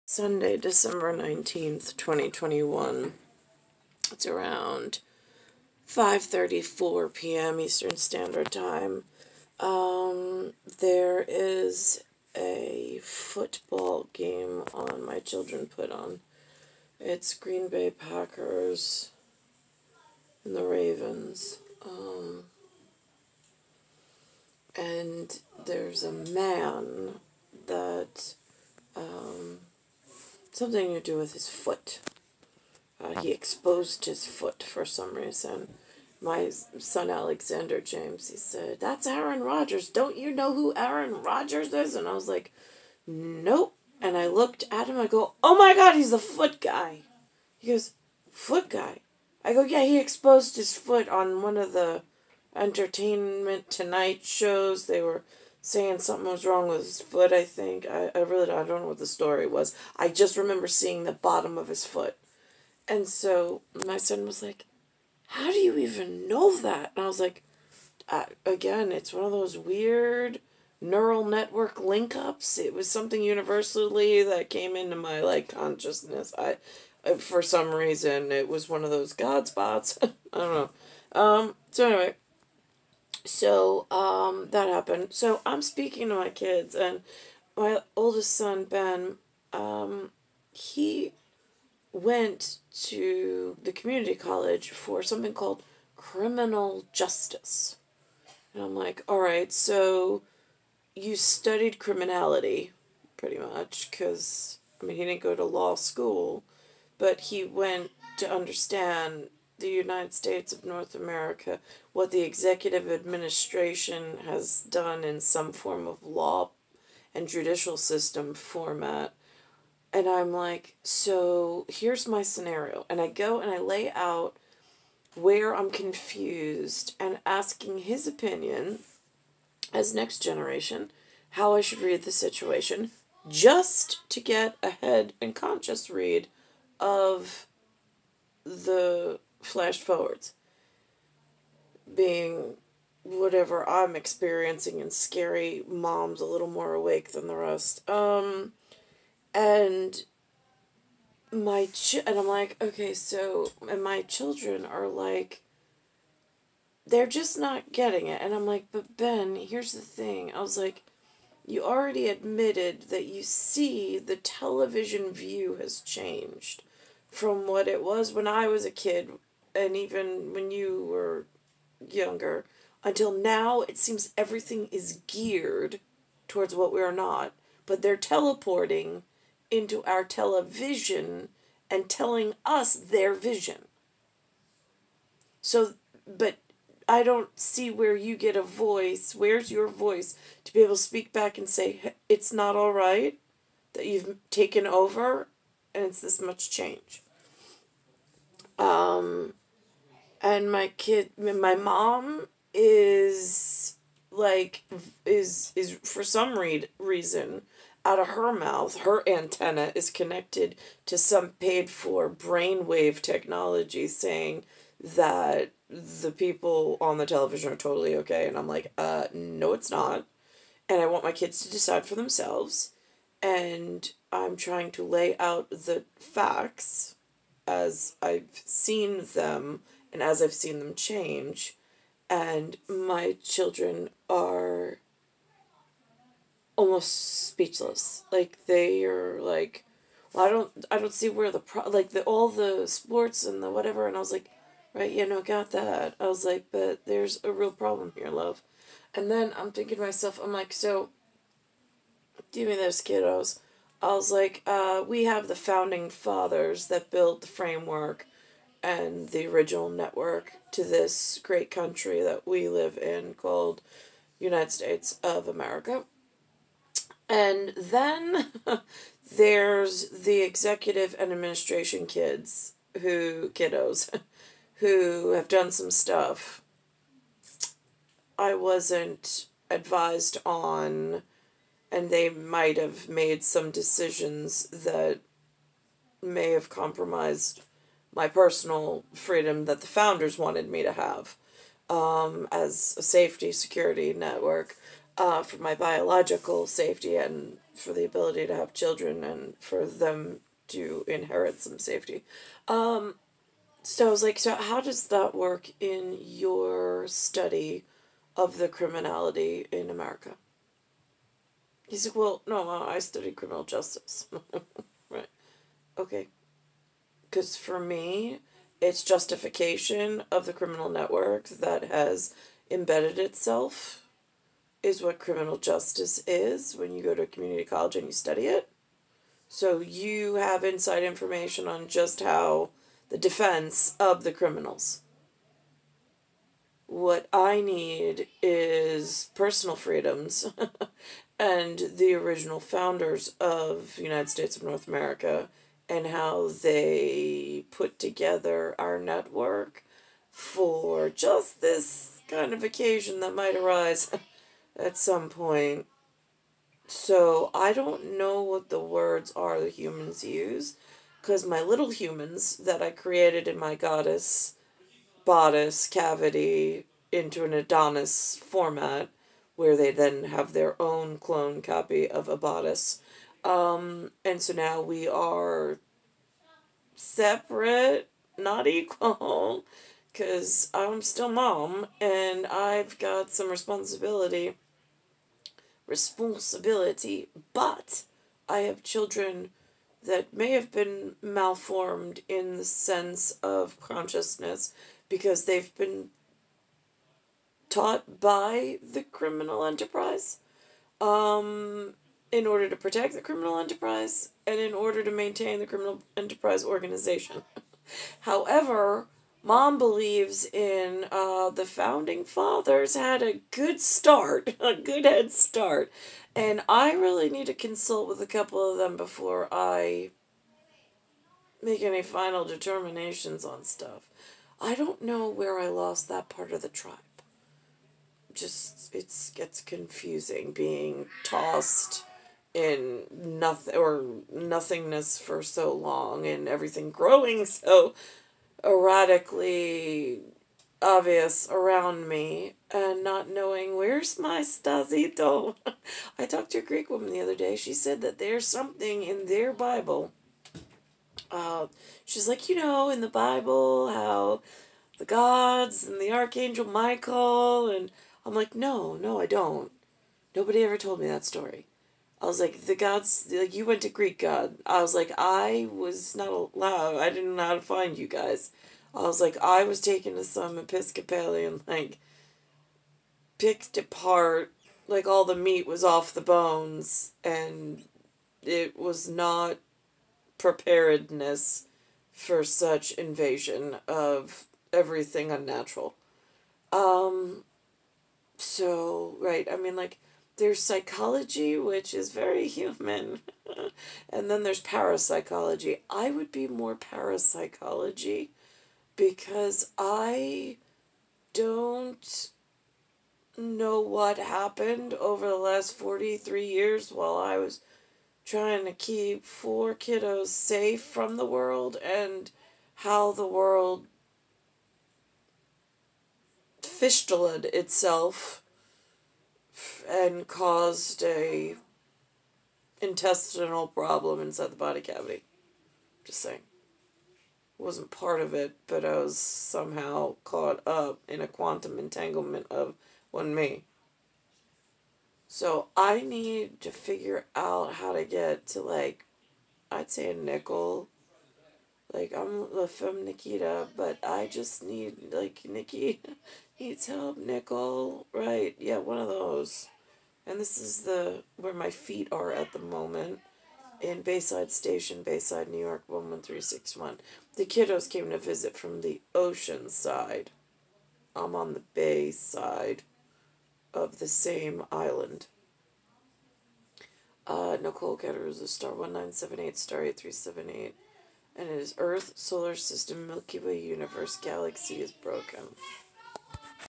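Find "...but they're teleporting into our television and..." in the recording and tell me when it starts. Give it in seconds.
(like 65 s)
177 s.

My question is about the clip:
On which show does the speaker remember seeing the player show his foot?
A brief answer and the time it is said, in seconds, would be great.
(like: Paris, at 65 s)
Entertainment Tonight, at 52 s.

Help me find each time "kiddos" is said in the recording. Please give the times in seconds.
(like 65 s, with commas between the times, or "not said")
252 s, 273 s, 509 s, 557 s.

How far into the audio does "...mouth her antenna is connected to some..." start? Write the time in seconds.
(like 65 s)
208 s.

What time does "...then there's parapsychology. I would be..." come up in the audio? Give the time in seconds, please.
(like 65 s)
494 s.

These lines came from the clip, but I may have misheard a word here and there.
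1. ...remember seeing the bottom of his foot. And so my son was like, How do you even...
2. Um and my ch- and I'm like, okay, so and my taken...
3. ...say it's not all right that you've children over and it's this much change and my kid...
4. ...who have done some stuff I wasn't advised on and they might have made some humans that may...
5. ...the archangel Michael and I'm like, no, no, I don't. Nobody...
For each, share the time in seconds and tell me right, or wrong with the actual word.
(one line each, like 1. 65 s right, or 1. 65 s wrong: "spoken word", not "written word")
1. 60 s right
2. 147 s wrong: "children", not "taken"
3. 191 s wrong: "taken", not "children"
4. 274 s wrong: "decisions", not "humans"
5. 455 s right.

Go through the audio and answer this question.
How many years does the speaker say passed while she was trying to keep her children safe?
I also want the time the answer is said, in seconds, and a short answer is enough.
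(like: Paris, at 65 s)
43, at 505 s.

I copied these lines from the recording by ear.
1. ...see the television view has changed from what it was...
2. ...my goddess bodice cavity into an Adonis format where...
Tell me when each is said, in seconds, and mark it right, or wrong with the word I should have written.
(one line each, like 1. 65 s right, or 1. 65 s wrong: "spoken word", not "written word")
1. 163 s right
2. 363 s right.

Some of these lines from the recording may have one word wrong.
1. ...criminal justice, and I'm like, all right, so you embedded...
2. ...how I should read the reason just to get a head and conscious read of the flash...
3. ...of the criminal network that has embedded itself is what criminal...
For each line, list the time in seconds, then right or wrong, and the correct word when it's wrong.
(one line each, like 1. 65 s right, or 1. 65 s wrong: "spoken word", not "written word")
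1. 95 s wrong: "studied", not "embedded"
2. 131 s wrong: "situation", not "reason"
3. 320 s right.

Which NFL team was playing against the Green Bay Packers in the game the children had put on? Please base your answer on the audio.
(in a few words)
Ravens.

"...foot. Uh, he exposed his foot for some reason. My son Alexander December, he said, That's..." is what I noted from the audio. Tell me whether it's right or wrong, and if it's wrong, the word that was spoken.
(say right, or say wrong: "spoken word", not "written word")
wrong: "James", not "December".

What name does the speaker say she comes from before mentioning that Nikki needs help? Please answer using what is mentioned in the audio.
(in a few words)
Nikita.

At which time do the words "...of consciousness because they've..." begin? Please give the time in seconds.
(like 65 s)
393 s.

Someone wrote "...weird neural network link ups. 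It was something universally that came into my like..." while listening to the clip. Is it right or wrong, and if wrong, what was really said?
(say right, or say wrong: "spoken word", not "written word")
right.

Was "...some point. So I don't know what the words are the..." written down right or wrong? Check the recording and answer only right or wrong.
right.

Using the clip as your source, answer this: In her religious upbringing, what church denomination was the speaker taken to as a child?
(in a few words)
Episcopalian.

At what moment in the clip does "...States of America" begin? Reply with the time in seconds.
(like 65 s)
264 s.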